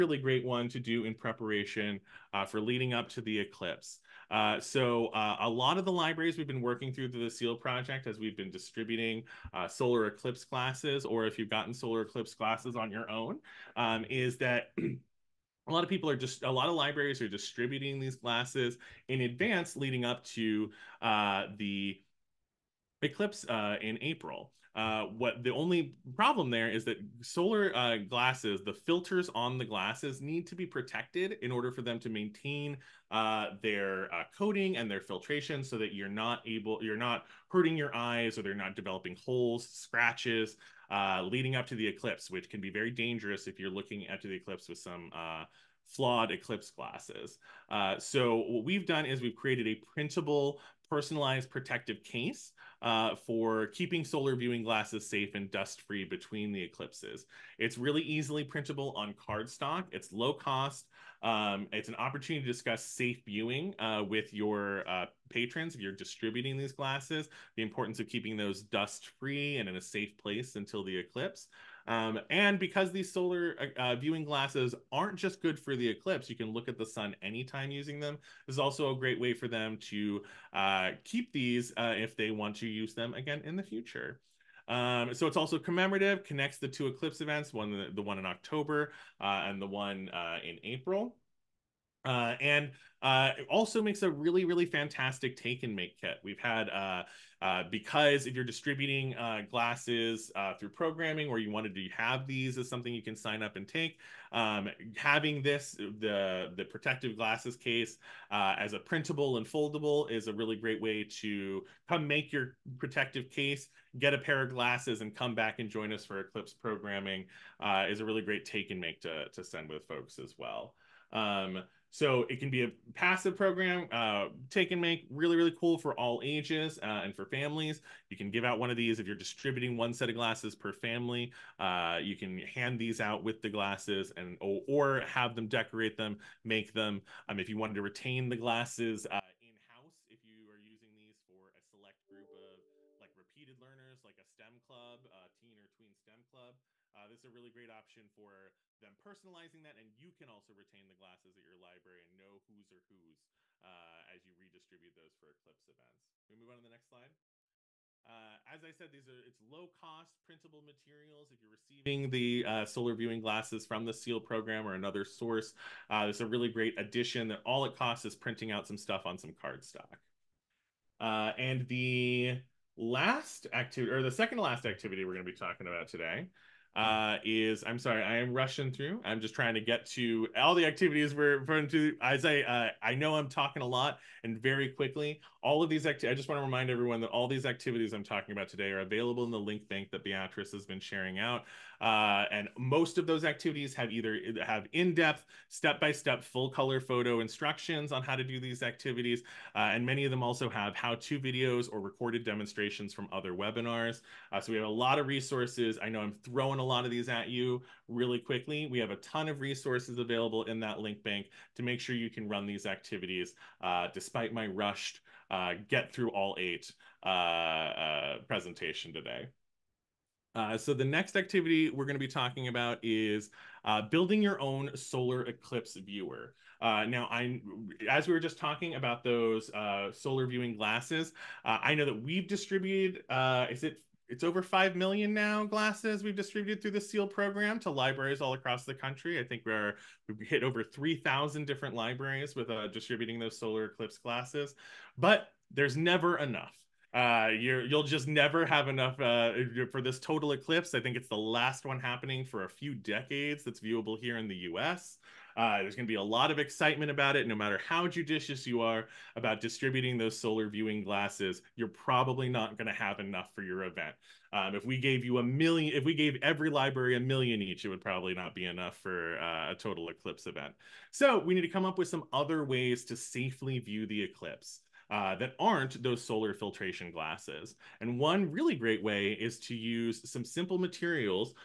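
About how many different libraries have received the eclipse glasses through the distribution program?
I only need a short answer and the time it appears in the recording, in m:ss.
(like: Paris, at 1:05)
over 3000, at 4:00.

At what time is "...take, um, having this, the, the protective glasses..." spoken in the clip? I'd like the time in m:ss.
1:43.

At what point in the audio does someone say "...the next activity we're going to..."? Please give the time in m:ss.
3:40.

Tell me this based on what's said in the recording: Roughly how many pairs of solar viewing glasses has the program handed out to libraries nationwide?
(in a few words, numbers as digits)
over 5 million.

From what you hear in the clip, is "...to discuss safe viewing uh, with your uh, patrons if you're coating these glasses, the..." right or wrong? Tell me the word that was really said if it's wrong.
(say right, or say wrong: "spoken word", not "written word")
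wrong: "distributing", not "coating".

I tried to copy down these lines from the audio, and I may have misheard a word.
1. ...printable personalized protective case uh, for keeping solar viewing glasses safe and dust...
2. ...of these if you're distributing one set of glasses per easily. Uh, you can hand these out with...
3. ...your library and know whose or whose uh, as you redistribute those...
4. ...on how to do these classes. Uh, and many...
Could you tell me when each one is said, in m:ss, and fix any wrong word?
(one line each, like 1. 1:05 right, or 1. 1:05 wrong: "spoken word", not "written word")
1. 0:49 right
2. 2:08 wrong: "family", not "easily"
3. 2:31 right
4. 3:17 wrong: "activities", not "classes".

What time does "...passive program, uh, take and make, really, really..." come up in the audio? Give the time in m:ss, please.
2:02.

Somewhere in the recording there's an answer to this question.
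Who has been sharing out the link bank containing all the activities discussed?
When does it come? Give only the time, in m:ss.
3:10.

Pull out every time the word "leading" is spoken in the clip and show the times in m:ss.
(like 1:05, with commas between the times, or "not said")
0:02, 0:19, 0:41.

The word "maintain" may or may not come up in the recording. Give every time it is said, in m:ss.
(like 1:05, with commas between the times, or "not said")
0:32.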